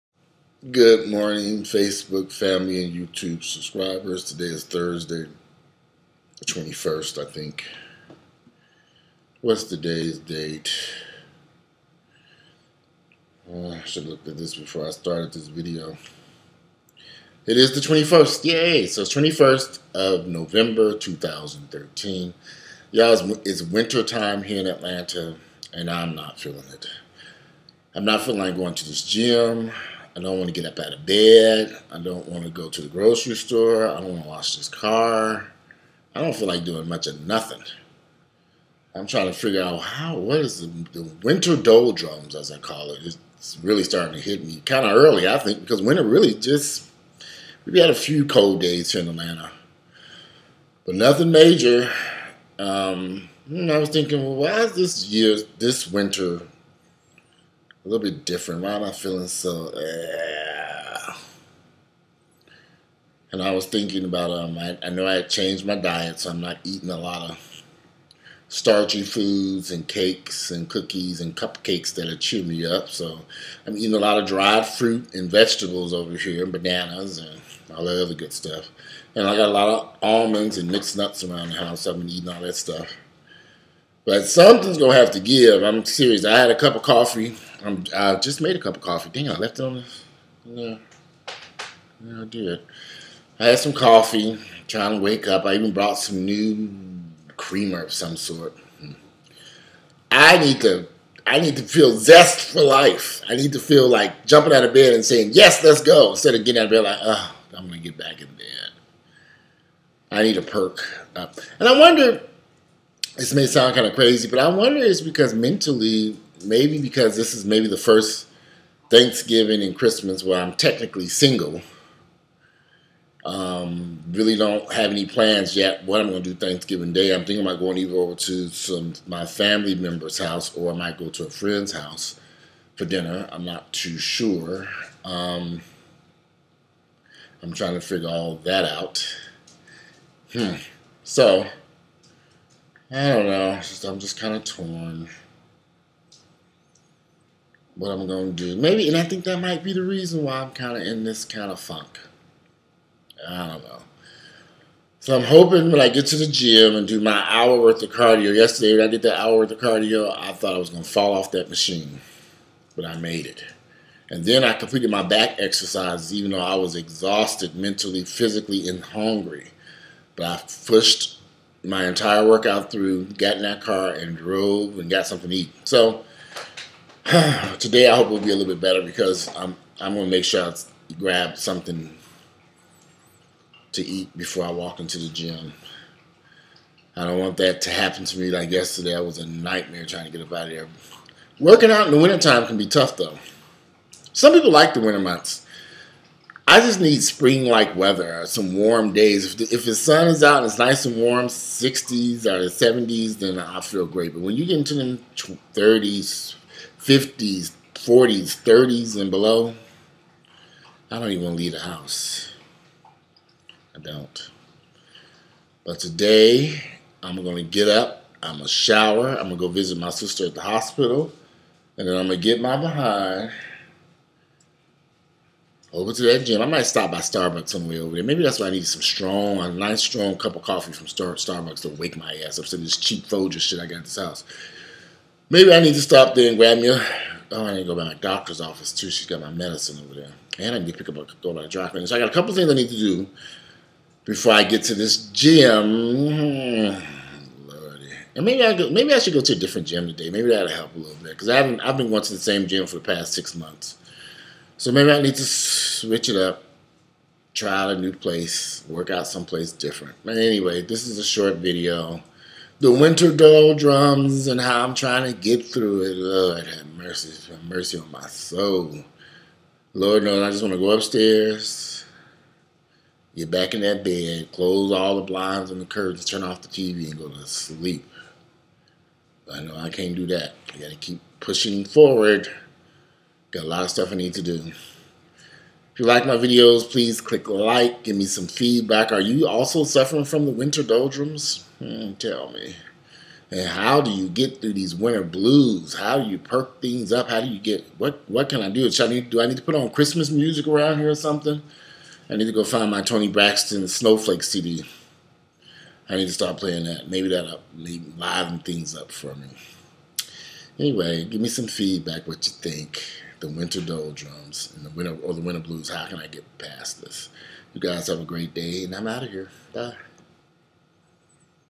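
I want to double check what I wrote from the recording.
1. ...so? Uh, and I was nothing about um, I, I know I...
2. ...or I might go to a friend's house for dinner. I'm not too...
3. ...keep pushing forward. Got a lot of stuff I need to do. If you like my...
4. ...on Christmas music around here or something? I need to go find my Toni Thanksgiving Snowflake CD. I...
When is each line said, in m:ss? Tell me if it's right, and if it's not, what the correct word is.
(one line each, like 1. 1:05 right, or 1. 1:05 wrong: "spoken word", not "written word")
1. 0:59 wrong: "thinking", not "nothing"
2. 2:10 right
3. 4:40 right
4. 4:59 wrong: "Braxton", not "Thanksgiving".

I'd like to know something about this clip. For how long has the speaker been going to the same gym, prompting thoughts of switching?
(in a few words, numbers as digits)
6 months.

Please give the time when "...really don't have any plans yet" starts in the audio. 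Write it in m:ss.
2:04.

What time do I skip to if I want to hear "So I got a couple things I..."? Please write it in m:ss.
4:01.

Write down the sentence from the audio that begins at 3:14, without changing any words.
Some people like the winter months.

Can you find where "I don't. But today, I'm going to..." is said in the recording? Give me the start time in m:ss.
3:33.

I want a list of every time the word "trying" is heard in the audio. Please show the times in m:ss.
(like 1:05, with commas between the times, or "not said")
0:39, 1:34, 2:17, 3:09, 4:24.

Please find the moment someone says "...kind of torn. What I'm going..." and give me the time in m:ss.
2:24.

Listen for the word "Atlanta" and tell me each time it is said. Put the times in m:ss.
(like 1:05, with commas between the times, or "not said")
0:24, 0:49.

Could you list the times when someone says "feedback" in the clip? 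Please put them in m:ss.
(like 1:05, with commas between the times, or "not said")
4:48, 5:11.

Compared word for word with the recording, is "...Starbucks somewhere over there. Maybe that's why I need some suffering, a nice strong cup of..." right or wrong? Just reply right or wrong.
wrong.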